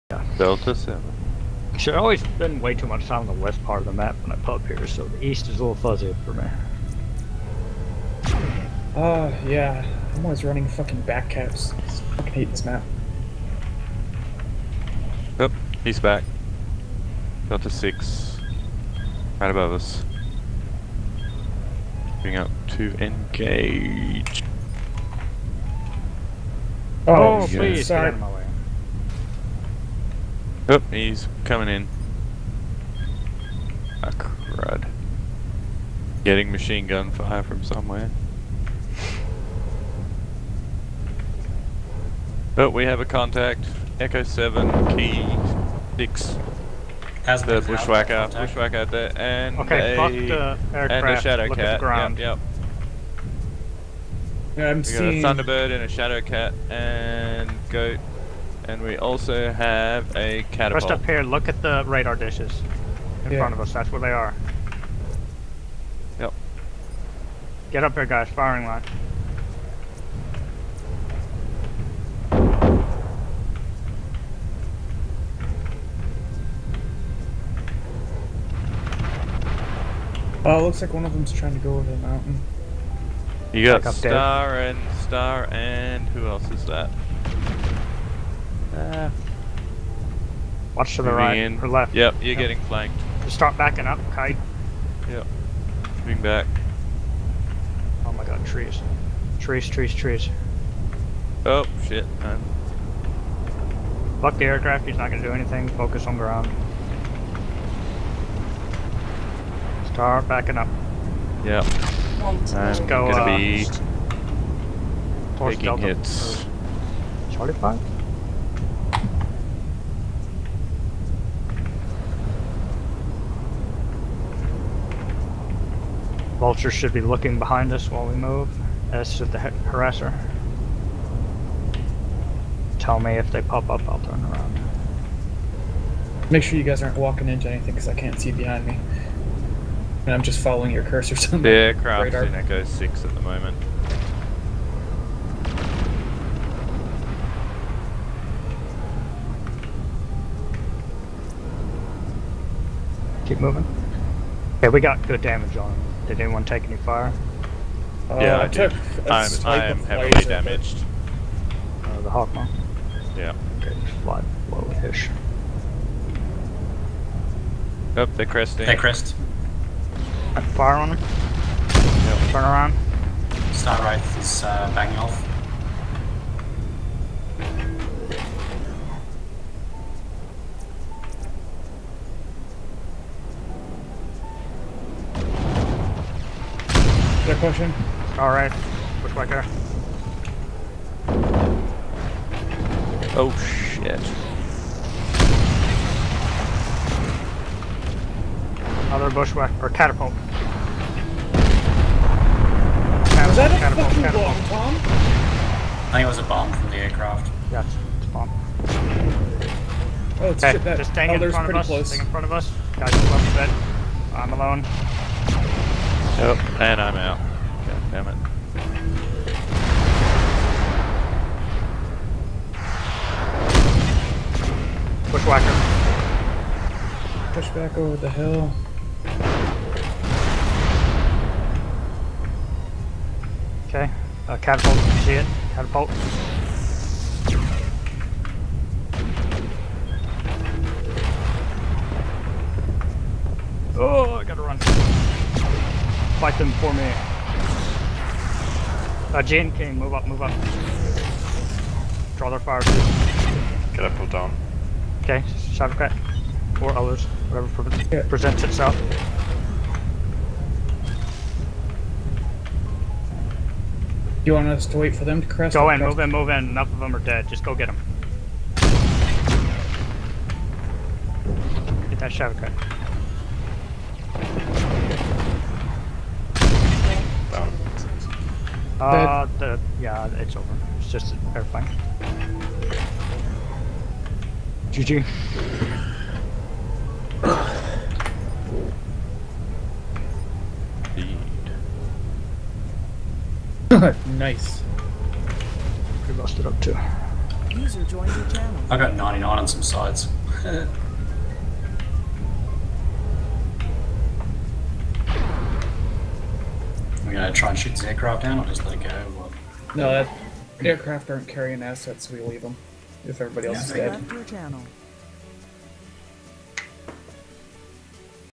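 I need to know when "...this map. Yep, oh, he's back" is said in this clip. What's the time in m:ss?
0:12.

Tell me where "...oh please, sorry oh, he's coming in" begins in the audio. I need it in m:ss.
0:27.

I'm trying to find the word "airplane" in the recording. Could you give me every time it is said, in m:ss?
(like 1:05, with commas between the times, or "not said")
4:41.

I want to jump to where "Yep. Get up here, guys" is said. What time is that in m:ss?
1:06.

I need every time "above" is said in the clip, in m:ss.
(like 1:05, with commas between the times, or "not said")
0:19.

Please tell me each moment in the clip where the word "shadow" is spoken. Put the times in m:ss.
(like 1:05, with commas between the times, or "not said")
0:51, 0:55, 4:15, 4:32.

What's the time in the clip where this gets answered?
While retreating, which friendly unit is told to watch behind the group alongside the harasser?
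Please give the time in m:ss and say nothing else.
2:06.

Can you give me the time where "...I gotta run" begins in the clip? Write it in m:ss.
4:04.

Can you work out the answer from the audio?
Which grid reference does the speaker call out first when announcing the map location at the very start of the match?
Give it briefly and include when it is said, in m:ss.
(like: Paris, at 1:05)
Delta 7, at 0:00.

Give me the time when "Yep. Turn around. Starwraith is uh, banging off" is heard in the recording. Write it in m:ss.
2:50.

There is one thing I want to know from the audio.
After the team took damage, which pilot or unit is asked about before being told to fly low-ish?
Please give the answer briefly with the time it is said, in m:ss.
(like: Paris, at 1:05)
Hawkman, at 2:42.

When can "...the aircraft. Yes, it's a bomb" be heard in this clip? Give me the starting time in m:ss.
3:26.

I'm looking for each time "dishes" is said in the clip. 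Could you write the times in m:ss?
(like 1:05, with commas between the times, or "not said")
1:02.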